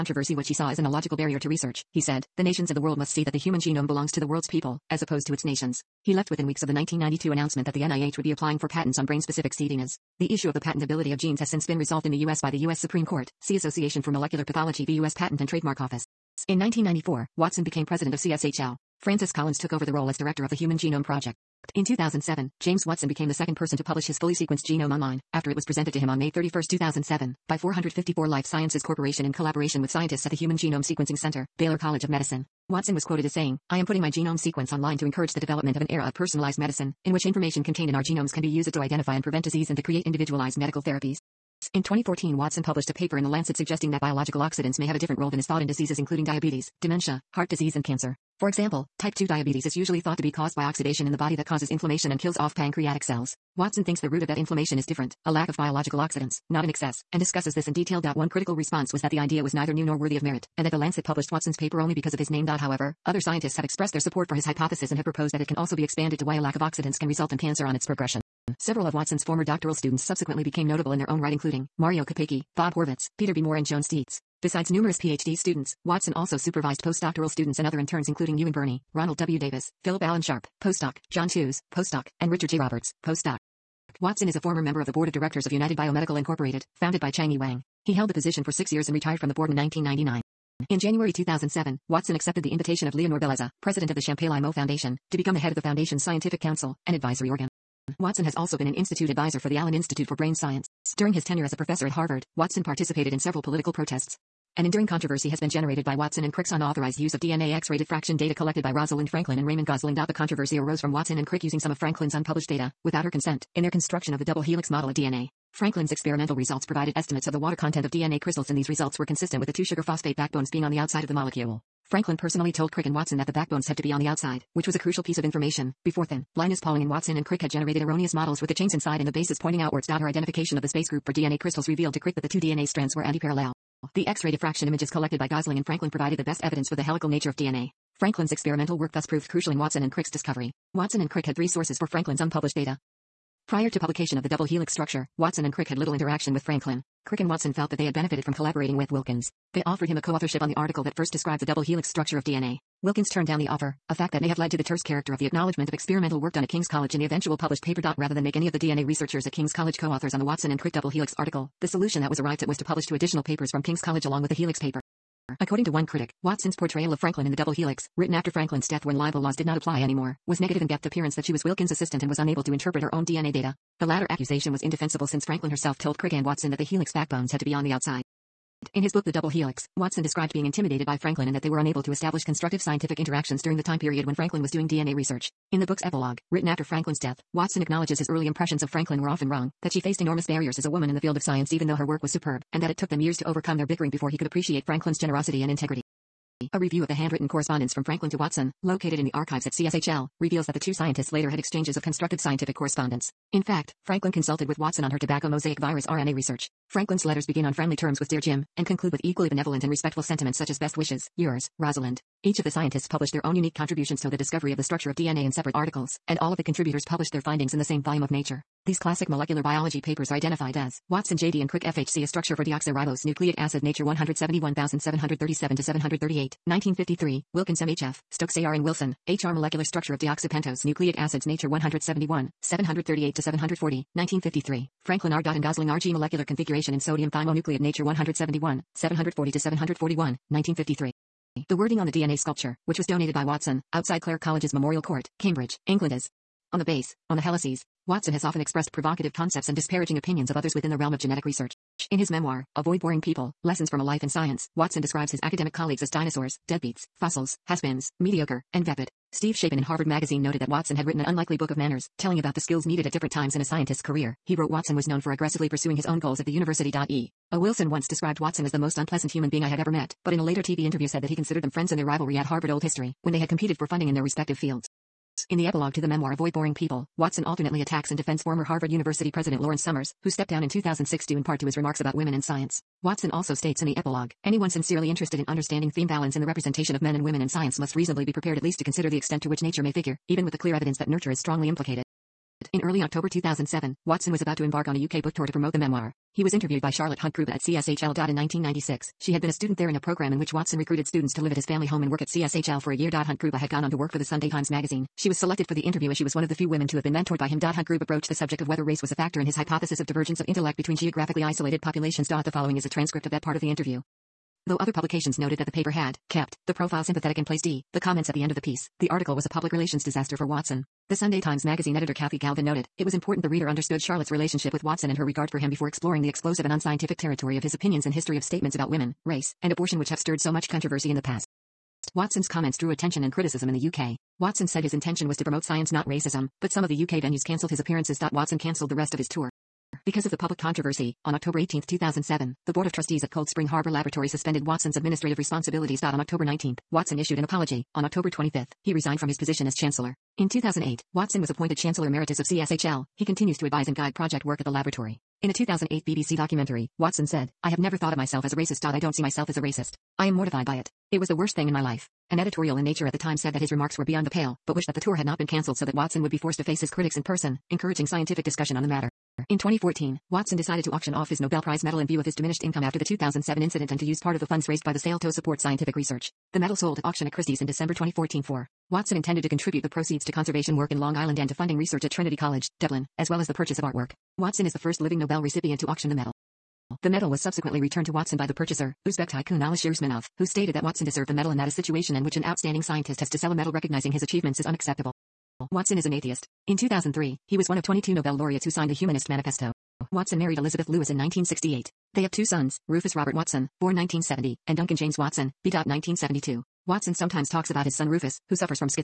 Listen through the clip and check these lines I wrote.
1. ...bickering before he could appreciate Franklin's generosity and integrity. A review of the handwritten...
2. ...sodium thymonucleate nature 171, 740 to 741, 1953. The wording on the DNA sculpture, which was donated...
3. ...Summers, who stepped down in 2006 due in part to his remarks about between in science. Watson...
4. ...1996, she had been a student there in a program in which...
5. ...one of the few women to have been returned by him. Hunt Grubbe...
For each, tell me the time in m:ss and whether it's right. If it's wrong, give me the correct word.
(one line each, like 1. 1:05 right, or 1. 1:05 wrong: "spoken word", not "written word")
1. 3:13 right
2. 3:56 right
3. 4:39 wrong: "women", not "between"
4. 4:58 right
5. 5:06 wrong: "mentored", not "returned".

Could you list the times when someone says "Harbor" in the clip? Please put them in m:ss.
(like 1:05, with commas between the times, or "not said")
5:43.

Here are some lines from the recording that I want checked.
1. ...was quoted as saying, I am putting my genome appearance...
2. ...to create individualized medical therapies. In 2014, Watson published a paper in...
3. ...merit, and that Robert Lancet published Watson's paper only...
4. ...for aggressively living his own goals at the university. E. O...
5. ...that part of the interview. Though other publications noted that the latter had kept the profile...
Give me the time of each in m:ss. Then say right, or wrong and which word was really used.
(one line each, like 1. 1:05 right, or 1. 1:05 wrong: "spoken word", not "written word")
1. 0:32 wrong: "sequence", not "appearance"
2. 0:39 right
3. 1:00 wrong: "The", not "Robert"
4. 4:25 wrong: "pursuing", not "living"
5. 5:13 wrong: "paper", not "latter".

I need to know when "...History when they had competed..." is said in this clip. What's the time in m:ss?
4:32.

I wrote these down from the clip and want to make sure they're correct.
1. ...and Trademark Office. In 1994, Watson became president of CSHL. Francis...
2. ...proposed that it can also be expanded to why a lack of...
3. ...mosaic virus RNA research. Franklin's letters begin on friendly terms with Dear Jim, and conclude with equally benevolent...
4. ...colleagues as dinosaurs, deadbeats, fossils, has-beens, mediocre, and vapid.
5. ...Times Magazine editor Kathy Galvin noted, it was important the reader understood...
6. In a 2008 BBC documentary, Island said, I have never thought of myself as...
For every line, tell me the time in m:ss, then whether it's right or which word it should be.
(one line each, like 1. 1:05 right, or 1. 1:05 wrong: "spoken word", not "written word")
1. 0:15 right
2. 1:05 right
3. 3:25 right
4. 4:15 right
5. 5:21 right
6. 5:55 wrong: "Watson", not "Island".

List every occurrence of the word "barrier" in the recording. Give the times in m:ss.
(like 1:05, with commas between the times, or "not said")
0:01, 3:10.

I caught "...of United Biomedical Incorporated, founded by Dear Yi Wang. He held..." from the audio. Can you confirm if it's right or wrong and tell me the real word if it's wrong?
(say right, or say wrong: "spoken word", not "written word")
wrong: "Chang", not "Dear".